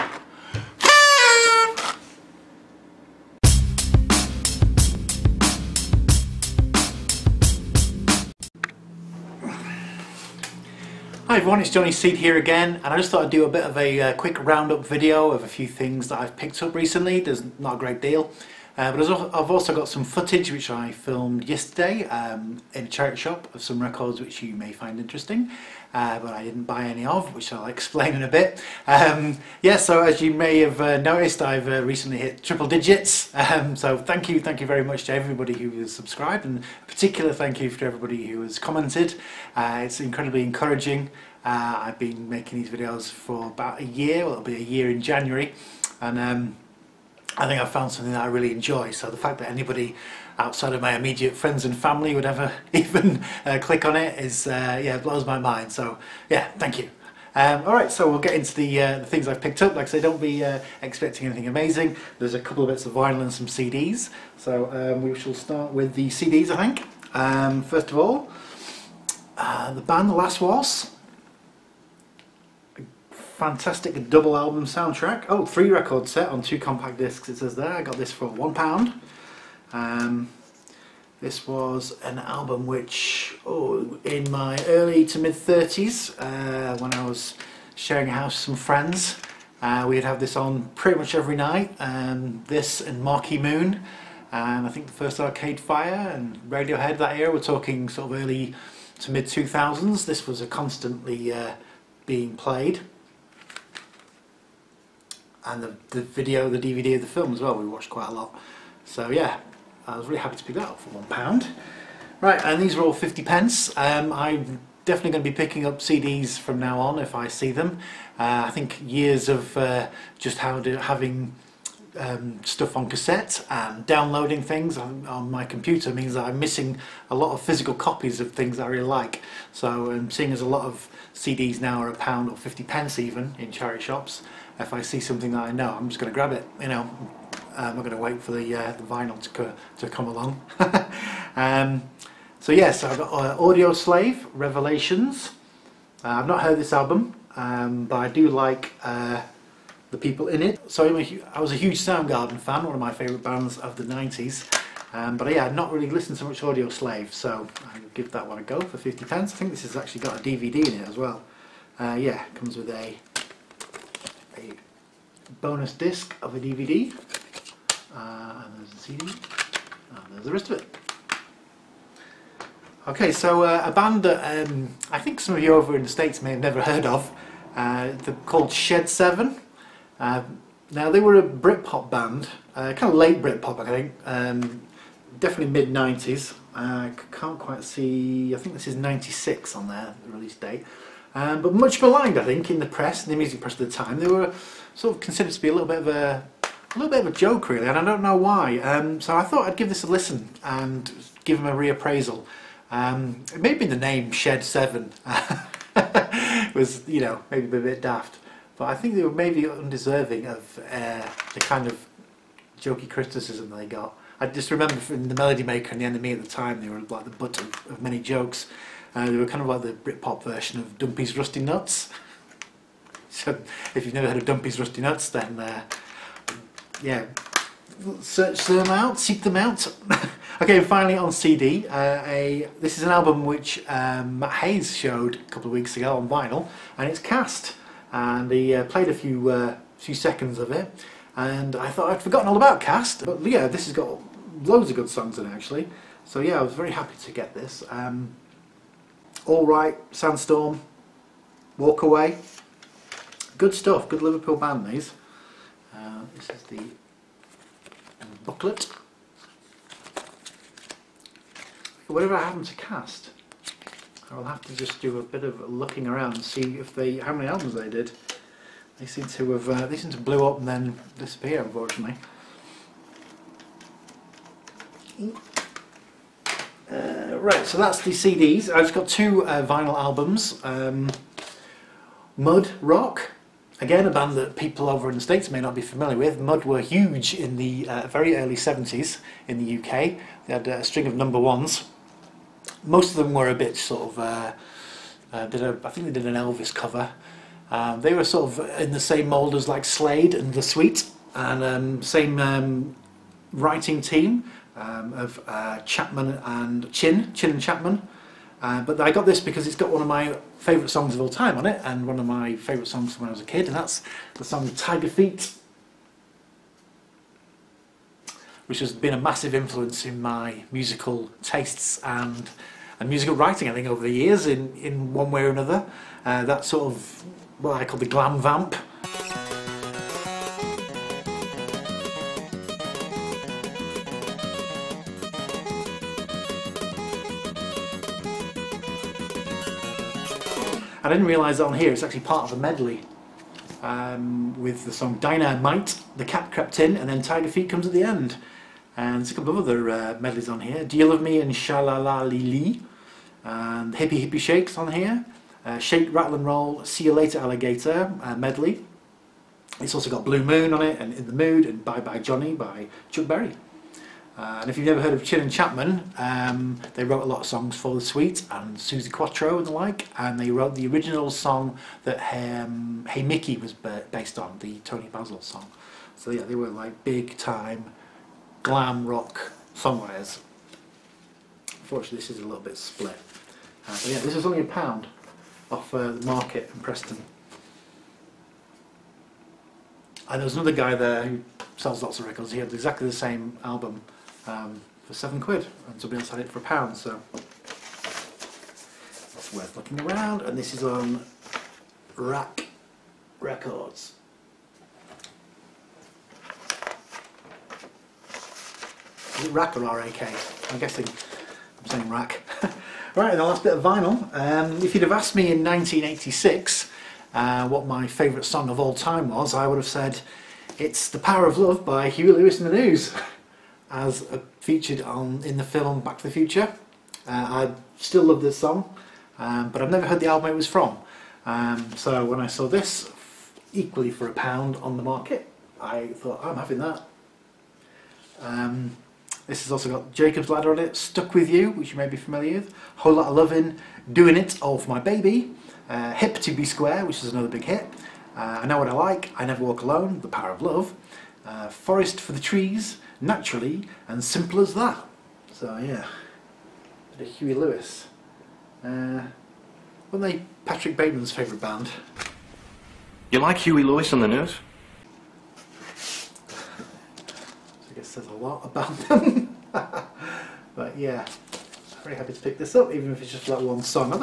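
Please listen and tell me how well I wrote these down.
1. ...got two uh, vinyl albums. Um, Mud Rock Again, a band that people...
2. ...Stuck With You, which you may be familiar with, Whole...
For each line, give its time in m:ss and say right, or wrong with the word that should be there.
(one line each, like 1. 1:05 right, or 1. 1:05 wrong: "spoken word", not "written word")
1. 4:38 right
2. 7:20 right.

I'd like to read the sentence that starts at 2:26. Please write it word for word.
Uh, I've not heard this album, um, but I do like uh, the people in it.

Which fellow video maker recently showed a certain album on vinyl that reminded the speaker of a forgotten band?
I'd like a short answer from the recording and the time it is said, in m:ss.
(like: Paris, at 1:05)
Matt Hayes, at 3:54.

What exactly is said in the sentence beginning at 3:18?
Um, so I thought I'd give this a listen and give him a reappraisal.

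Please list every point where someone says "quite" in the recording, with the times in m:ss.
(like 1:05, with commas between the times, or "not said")
1:47, 3:07.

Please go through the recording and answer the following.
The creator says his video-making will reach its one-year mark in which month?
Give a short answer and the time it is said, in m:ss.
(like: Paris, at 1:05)
January, at 0:45.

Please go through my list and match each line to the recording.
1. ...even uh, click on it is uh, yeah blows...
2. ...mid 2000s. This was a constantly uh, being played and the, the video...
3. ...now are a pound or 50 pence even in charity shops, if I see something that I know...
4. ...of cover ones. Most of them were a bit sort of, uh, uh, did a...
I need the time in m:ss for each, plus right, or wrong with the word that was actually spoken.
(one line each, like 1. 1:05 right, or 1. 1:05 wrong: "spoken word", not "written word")
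1. 0:52 right
2. 1:39 right
3. 2:11 right
4. 4:50 wrong: "number", not "cover".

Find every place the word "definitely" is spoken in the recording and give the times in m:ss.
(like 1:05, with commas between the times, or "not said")
1:54, 3:05.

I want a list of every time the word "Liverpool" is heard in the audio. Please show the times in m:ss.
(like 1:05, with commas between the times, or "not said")
4:14.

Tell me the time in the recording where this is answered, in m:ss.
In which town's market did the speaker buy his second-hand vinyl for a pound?
6:26.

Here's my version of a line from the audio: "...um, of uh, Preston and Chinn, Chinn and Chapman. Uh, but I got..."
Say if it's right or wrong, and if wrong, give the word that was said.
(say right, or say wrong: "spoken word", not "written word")
wrong: "Chapman", not "Preston".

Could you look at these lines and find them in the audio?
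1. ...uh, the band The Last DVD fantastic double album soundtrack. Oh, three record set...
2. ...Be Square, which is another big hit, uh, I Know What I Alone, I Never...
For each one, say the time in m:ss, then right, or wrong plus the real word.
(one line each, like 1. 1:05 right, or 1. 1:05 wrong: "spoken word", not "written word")
1. 1:09 wrong: "Waltz", not "DVD"
2. 7:26 wrong: "Like", not "Alone".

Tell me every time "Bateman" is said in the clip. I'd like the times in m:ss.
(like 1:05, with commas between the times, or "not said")
7:40.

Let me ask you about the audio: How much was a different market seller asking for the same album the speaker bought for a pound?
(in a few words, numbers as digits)
£7.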